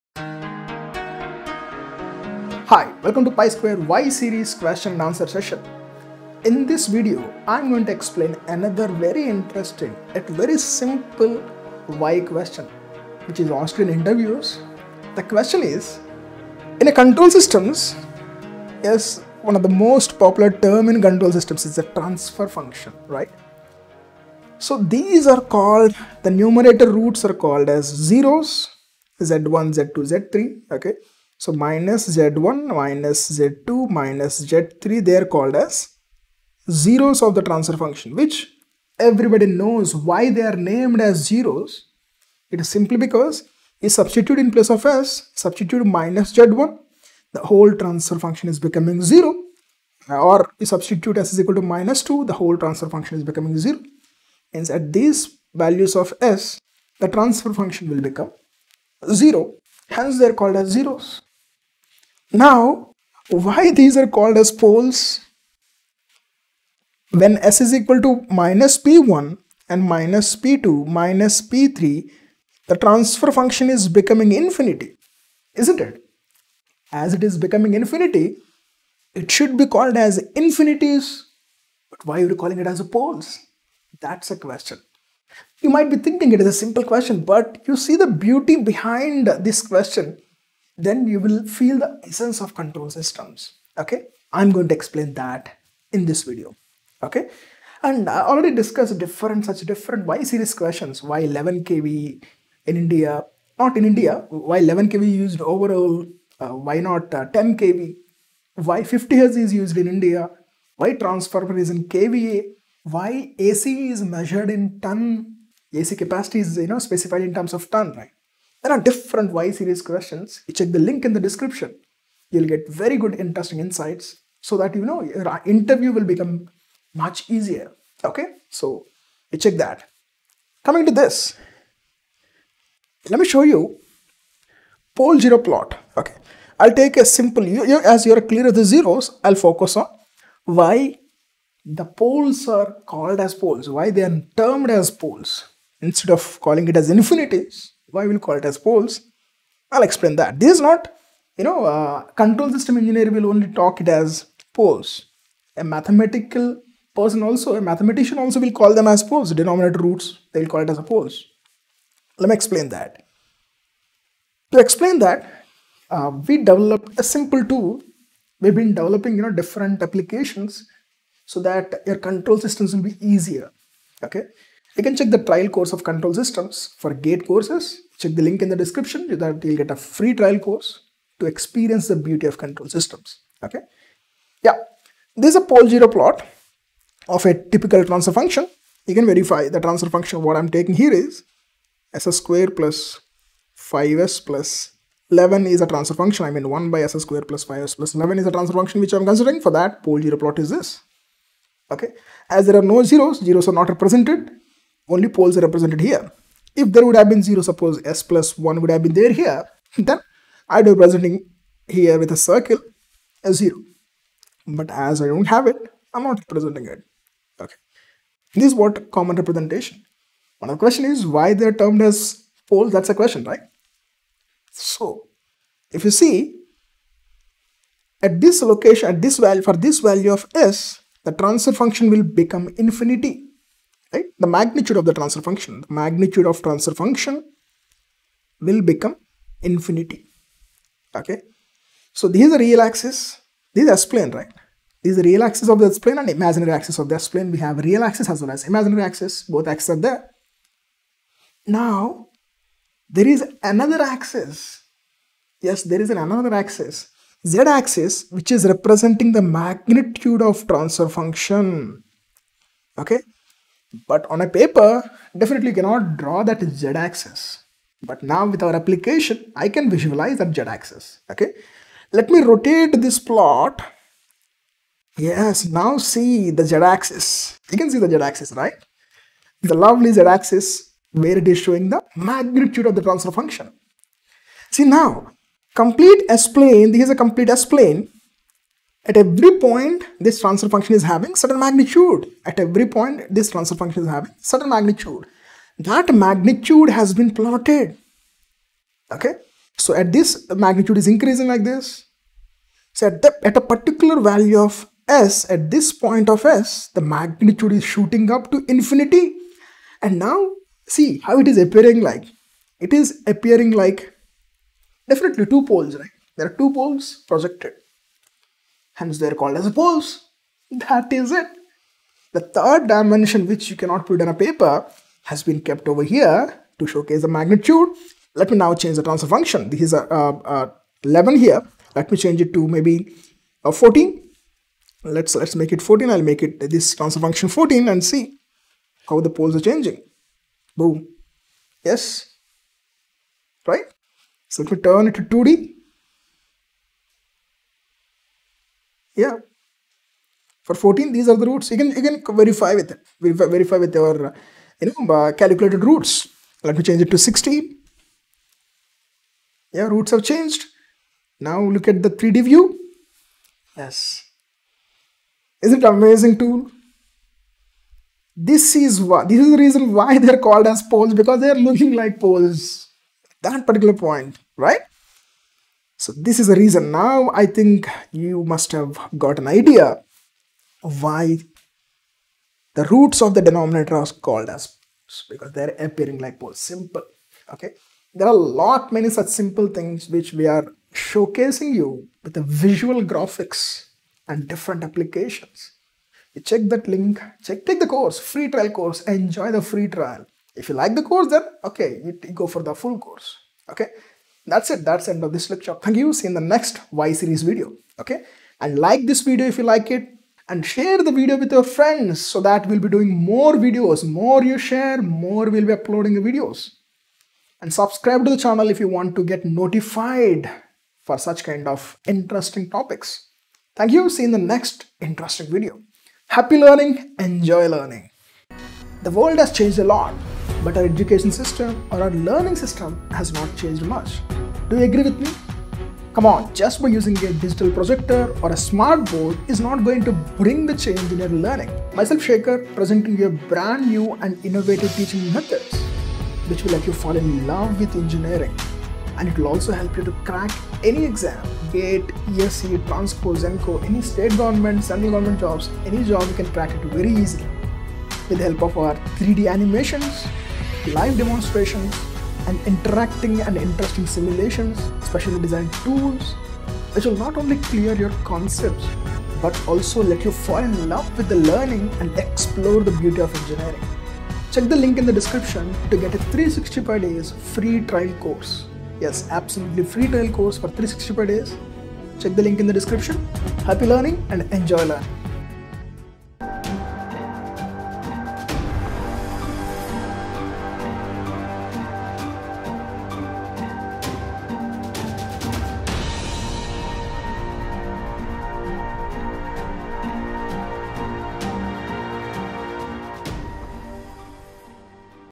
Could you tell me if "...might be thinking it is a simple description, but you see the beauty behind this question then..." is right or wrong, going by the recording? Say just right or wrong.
wrong.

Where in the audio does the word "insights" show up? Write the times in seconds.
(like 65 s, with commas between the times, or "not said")
123 s.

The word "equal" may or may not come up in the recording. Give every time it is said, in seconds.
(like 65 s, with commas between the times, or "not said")
51 s, 67 s.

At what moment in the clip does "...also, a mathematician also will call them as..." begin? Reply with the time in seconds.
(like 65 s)
157 s.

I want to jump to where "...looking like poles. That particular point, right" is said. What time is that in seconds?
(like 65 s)
371 s.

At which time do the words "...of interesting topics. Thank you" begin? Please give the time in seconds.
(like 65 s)
421 s.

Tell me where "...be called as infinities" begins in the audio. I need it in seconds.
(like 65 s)
79 s.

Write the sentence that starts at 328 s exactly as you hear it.
Let me now change the transfer function.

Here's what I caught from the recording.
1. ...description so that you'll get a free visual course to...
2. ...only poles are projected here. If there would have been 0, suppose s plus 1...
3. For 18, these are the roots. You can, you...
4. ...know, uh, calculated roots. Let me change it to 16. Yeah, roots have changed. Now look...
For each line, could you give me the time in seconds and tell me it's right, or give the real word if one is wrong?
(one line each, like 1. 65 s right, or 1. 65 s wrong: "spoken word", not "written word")
1. 178 s wrong: "trial", not "visual"
2. 204 s wrong: "represented", not "projected"
3. 350 s wrong: "14", not "18"
4. 354 s right.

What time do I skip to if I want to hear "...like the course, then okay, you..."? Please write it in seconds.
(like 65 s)
400 s.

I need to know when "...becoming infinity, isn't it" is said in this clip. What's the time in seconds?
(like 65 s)
73 s.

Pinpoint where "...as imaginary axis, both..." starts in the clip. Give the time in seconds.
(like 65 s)
248 s.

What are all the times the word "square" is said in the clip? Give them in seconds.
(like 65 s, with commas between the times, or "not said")
3 s, 192 s, 196 s.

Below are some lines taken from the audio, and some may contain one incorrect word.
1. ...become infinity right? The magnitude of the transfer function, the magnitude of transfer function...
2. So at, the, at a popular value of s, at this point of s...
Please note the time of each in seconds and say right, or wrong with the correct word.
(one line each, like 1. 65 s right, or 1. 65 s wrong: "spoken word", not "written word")
1. 232 s right
2. 302 s wrong: "particular", not "popular".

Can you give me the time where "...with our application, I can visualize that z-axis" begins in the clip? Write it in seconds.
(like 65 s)
268 s.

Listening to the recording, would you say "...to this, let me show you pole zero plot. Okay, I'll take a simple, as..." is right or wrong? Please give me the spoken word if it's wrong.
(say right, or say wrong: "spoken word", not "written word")
right.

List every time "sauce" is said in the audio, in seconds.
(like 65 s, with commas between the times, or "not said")
not said.